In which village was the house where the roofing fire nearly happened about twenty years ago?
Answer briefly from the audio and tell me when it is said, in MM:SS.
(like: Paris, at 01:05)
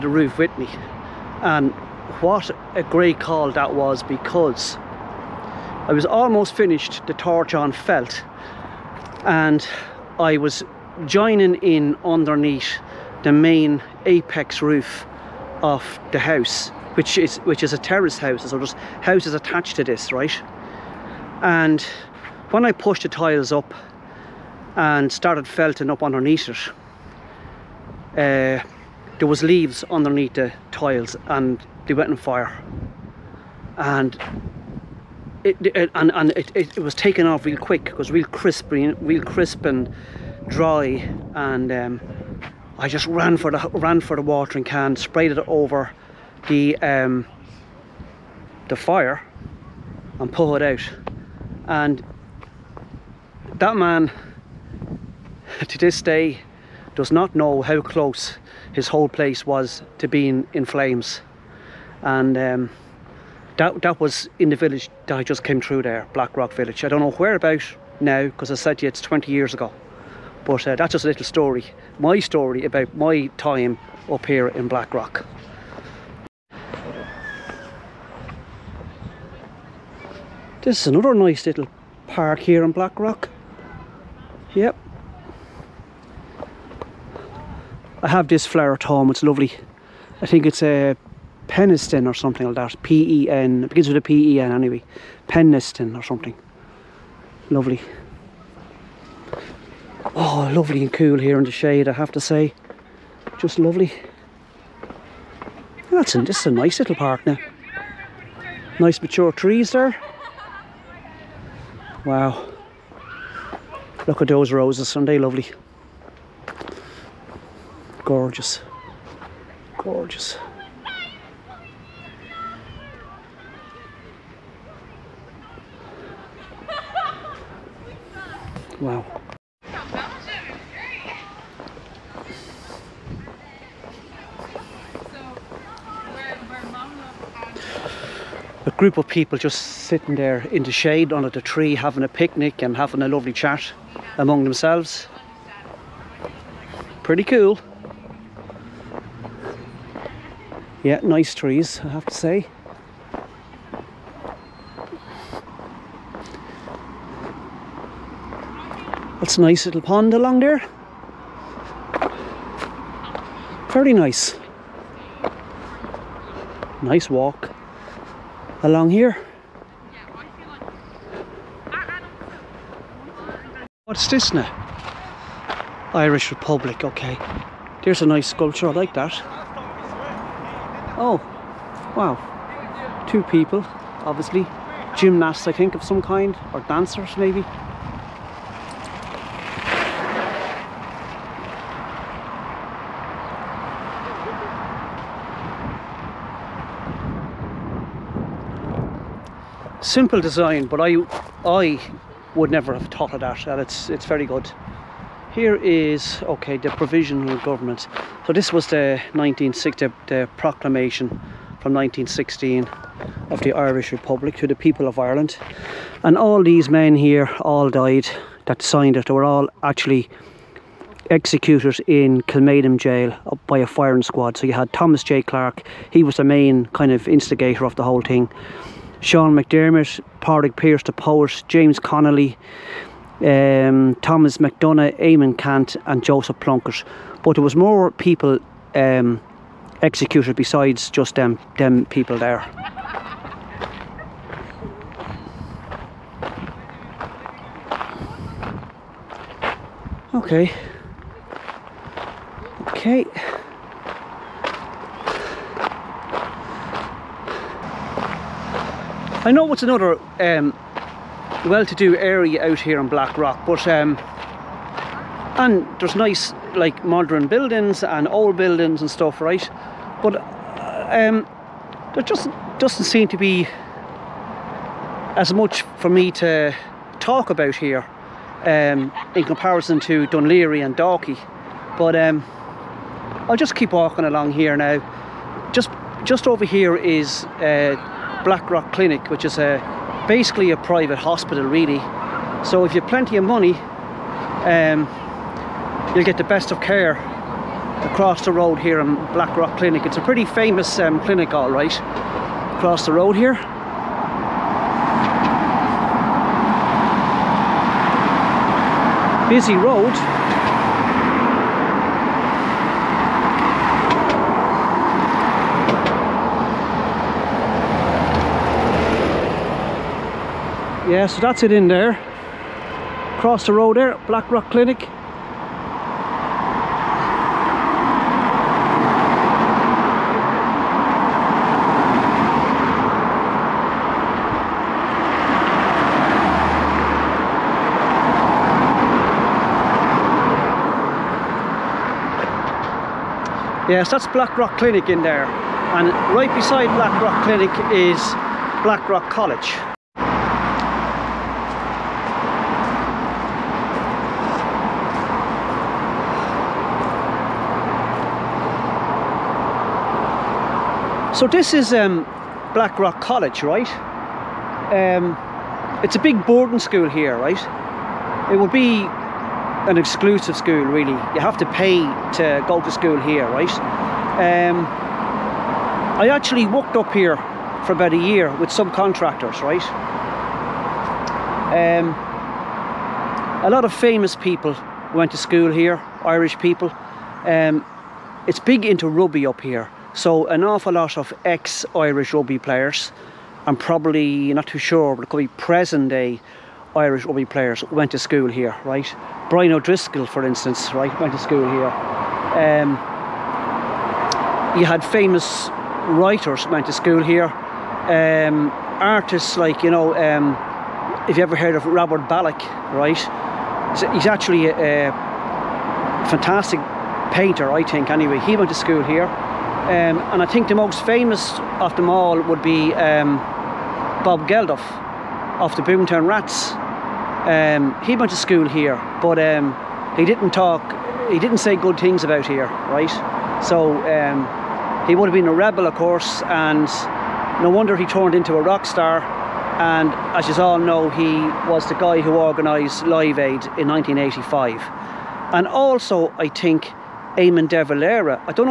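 Blackrock Village, at 01:06.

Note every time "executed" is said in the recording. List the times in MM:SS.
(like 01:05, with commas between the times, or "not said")
03:41, 03:59.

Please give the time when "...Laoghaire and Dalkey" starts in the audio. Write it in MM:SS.
04:40.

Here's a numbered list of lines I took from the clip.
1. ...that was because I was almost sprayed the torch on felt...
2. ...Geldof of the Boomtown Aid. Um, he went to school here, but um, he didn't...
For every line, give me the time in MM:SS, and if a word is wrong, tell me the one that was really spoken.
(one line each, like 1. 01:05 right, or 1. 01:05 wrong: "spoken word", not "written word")
1. 00:03 wrong: "finished", not "sprayed"
2. 07:04 wrong: "Rats", not "Aid".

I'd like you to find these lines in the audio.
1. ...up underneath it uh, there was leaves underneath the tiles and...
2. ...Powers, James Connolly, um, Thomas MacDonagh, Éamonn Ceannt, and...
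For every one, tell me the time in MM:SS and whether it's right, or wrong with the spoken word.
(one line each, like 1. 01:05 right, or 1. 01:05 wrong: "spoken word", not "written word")
1. 00:25 right
2. 03:50 right.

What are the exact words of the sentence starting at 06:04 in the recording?
Um, it's a big boarding school here, right?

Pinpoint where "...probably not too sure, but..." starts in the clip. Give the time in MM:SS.
06:33.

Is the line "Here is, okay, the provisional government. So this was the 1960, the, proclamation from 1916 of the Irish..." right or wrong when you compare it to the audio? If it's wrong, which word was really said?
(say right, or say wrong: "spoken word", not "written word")
right.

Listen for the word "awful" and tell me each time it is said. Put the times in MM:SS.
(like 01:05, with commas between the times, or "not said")
06:30.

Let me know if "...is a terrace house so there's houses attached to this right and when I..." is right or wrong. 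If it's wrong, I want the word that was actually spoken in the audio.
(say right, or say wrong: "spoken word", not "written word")
right.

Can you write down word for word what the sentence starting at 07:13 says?
So um, he would have been a rebel, of course, and no wonder he turned into a rock star.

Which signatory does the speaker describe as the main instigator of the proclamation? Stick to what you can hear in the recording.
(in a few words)
Thomas J. Clarke.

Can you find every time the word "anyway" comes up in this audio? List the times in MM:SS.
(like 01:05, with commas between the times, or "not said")
01:34, 06:57.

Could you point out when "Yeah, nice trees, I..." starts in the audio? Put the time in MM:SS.
02:30.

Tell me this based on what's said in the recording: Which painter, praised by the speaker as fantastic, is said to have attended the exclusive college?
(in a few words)
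Robert Ballagh.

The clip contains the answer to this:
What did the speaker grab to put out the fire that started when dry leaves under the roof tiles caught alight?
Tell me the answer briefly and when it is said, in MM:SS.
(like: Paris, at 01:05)
watering can, at 00:44.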